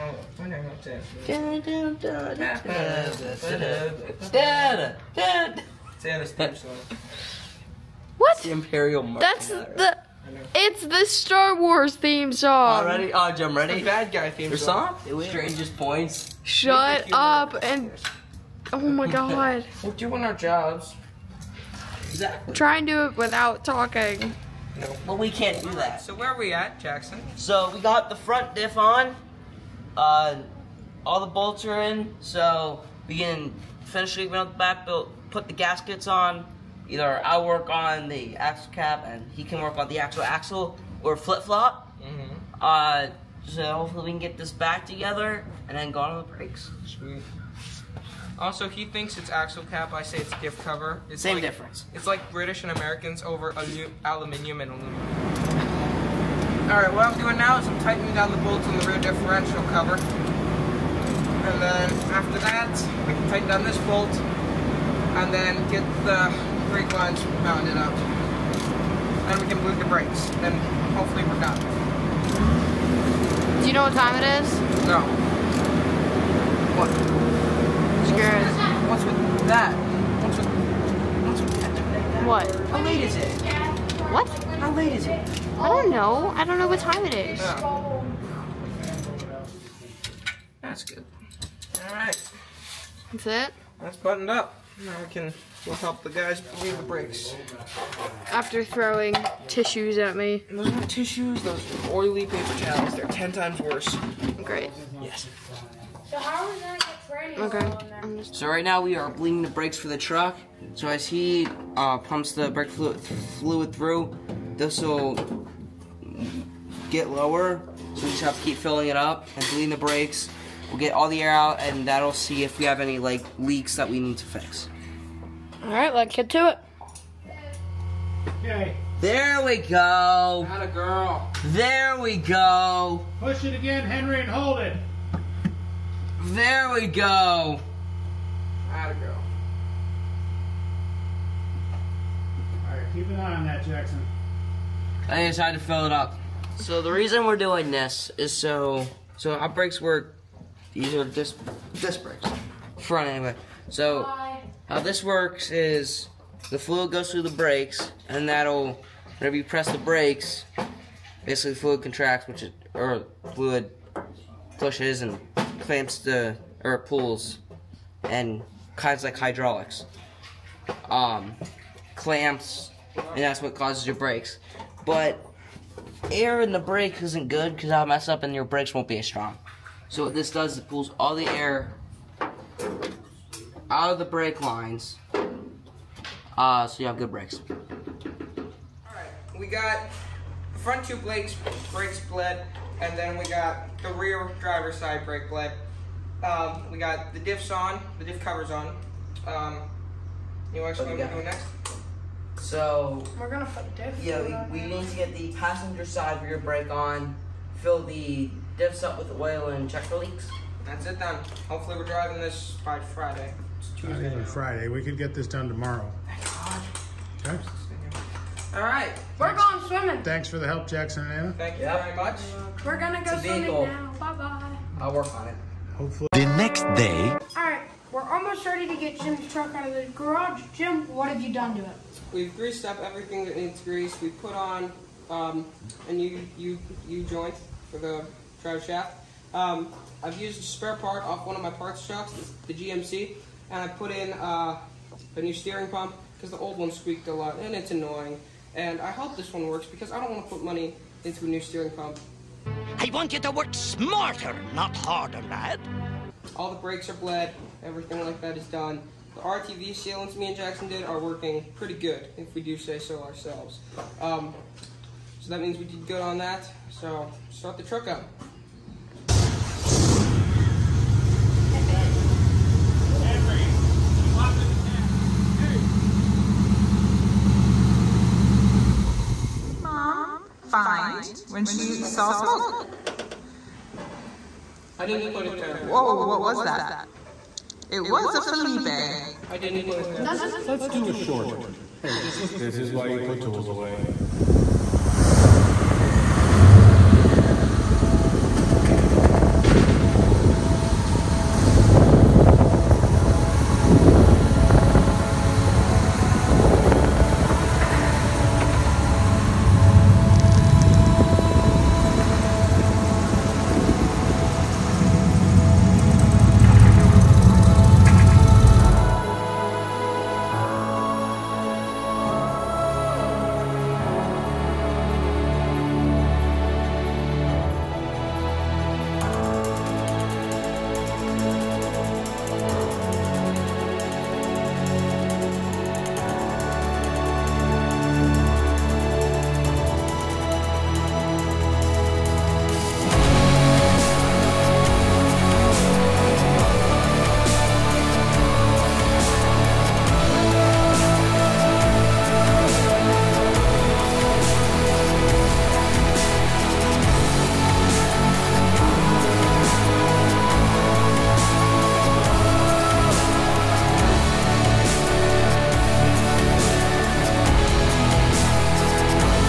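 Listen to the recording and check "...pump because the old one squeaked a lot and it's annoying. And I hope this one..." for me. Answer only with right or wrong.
right.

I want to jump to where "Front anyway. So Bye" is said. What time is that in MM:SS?
02:32.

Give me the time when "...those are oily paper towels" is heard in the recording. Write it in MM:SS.
01:41.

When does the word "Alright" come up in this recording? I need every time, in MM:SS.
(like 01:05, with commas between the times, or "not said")
01:31, 02:22.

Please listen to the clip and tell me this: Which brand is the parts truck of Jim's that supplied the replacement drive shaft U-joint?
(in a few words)
GMC.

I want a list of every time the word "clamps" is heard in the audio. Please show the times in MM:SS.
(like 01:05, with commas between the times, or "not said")
02:45, 02:51.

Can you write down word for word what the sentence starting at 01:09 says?
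and we can move the brakes and hopefully we're done.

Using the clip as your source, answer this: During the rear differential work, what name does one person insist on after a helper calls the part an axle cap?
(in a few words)
diff cover.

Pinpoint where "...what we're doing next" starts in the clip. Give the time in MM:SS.
03:20.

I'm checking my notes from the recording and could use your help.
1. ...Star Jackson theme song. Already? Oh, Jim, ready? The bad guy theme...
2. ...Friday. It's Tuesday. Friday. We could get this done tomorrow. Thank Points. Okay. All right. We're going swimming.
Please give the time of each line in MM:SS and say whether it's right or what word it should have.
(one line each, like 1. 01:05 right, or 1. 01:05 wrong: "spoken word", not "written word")
1. 00:11 wrong: "Wars", not "Jackson"
2. 03:32 wrong: "God", not "Points".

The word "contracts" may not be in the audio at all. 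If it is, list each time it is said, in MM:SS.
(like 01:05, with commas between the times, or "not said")
02:41.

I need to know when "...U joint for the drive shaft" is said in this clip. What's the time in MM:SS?
03:56.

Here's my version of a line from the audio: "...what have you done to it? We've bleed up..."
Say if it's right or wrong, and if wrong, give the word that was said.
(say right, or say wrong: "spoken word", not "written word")
wrong: "greased", not "bleed".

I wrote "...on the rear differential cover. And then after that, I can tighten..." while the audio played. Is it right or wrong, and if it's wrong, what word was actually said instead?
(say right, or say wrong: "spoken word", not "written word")
right.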